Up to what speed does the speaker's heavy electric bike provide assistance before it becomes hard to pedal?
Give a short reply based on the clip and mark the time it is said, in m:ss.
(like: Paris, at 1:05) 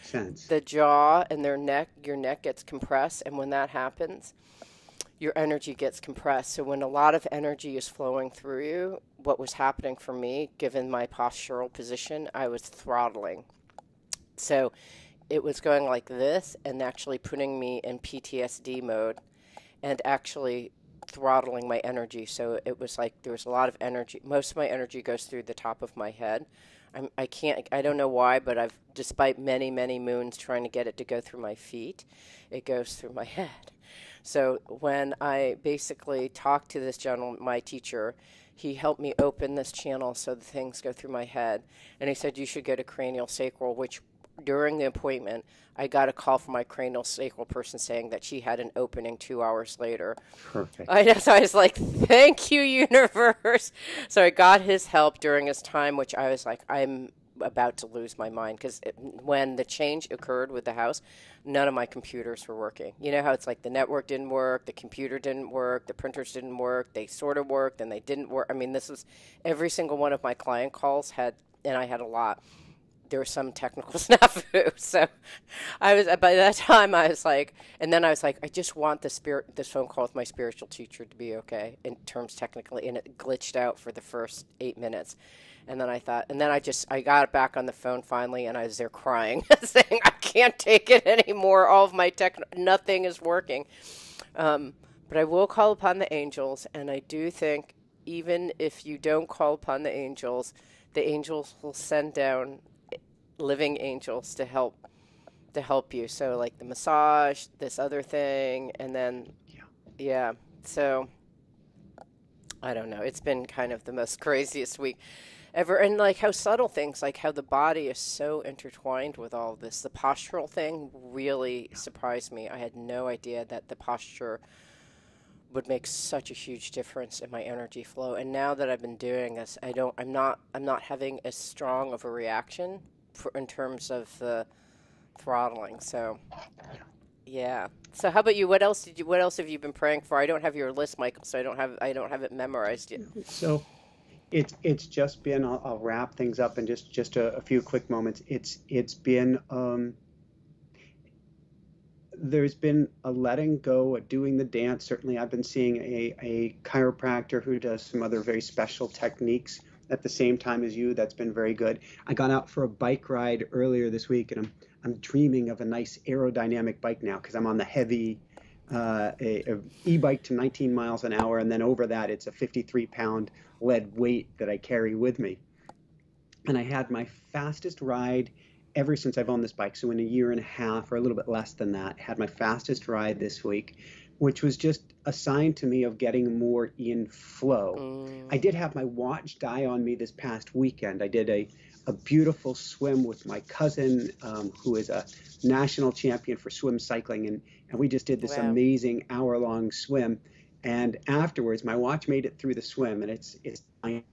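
19 mph, at 2:50.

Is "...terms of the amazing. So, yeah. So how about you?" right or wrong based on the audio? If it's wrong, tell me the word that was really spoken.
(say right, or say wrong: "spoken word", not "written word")
wrong: "throttling", not "amazing".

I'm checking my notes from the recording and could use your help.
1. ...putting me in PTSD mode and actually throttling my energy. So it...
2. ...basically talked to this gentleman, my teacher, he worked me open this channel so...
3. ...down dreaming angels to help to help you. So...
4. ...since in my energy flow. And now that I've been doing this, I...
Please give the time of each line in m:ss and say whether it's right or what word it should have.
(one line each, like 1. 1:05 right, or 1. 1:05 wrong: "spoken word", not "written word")
1. 0:17 right
2. 0:35 wrong: "helped", not "worked"
3. 1:42 wrong: "living", not "dreaming"
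4. 2:06 wrong: "difference", not "since".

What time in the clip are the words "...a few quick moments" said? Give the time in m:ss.
2:27.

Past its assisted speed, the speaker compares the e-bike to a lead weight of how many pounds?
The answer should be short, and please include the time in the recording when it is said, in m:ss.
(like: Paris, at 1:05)
53 pounds, at 2:52.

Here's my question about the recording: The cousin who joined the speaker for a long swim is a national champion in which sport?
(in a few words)
swim cycling.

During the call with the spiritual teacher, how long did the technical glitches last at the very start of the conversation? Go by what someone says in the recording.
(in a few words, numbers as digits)
8 minutes.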